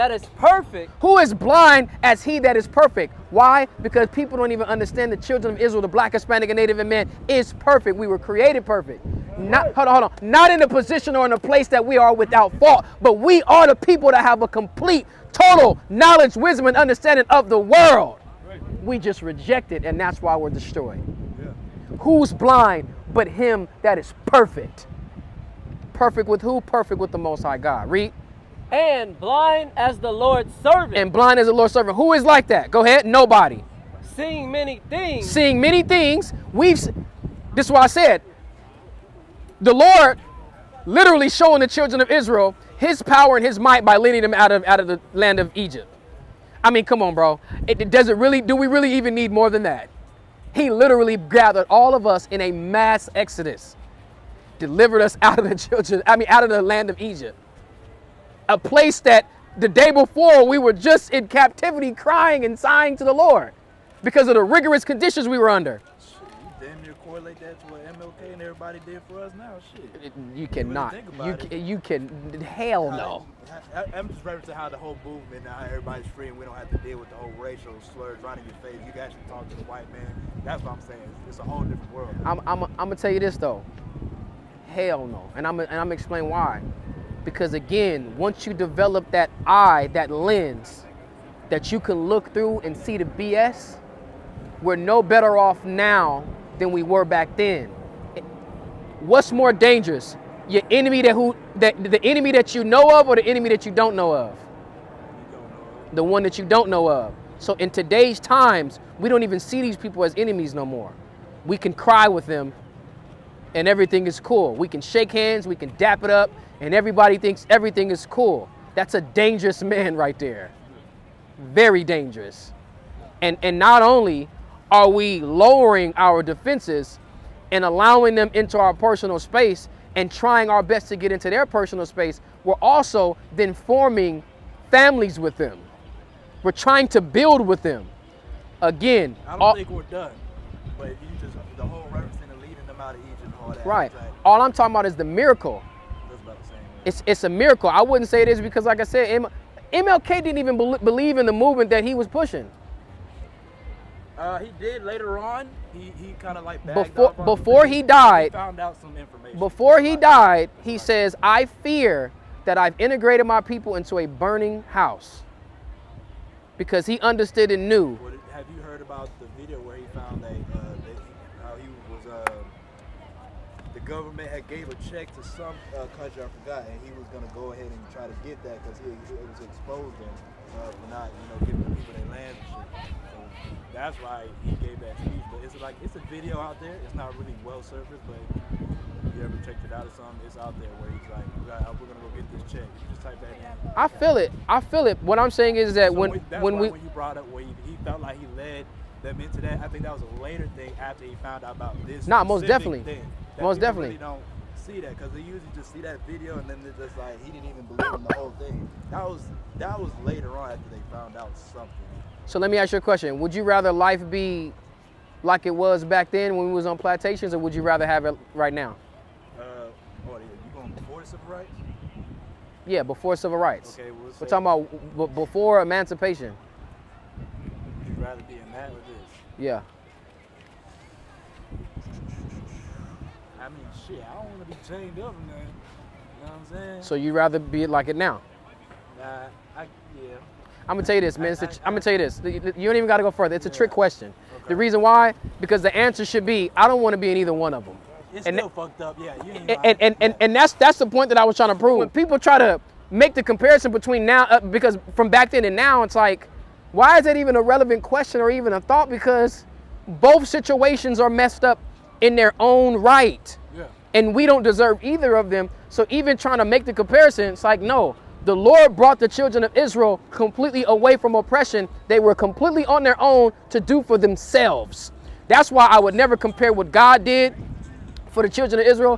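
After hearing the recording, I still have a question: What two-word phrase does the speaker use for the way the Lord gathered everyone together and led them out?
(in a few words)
mass exodus.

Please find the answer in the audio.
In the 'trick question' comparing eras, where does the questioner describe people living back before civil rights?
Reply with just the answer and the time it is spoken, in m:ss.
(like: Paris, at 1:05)
plantations, at 3:36.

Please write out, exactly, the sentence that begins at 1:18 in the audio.
You can actually talk to the white man.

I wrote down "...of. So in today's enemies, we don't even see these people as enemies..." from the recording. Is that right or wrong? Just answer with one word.
wrong.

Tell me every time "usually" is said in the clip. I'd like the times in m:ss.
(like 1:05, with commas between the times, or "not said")
3:25.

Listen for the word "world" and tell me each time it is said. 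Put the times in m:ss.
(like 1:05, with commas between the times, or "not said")
0:17, 1:21.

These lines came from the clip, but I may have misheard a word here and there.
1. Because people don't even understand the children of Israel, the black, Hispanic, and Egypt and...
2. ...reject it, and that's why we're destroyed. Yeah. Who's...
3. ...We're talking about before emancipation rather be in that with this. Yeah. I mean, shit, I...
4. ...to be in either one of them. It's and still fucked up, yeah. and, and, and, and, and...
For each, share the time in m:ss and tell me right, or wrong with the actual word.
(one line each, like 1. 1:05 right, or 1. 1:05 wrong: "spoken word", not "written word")
1. 0:03 wrong: "Native", not "Egypt"
2. 0:19 right
3. 3:44 right
4. 4:06 right.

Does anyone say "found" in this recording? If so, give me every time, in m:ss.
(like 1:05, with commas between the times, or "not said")
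2:38, 3:21, 3:30.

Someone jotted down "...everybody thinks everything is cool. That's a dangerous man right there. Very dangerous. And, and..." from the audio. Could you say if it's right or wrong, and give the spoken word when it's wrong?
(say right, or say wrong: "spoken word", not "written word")
right.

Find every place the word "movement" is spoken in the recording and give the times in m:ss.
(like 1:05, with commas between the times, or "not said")
1:15, 2:31.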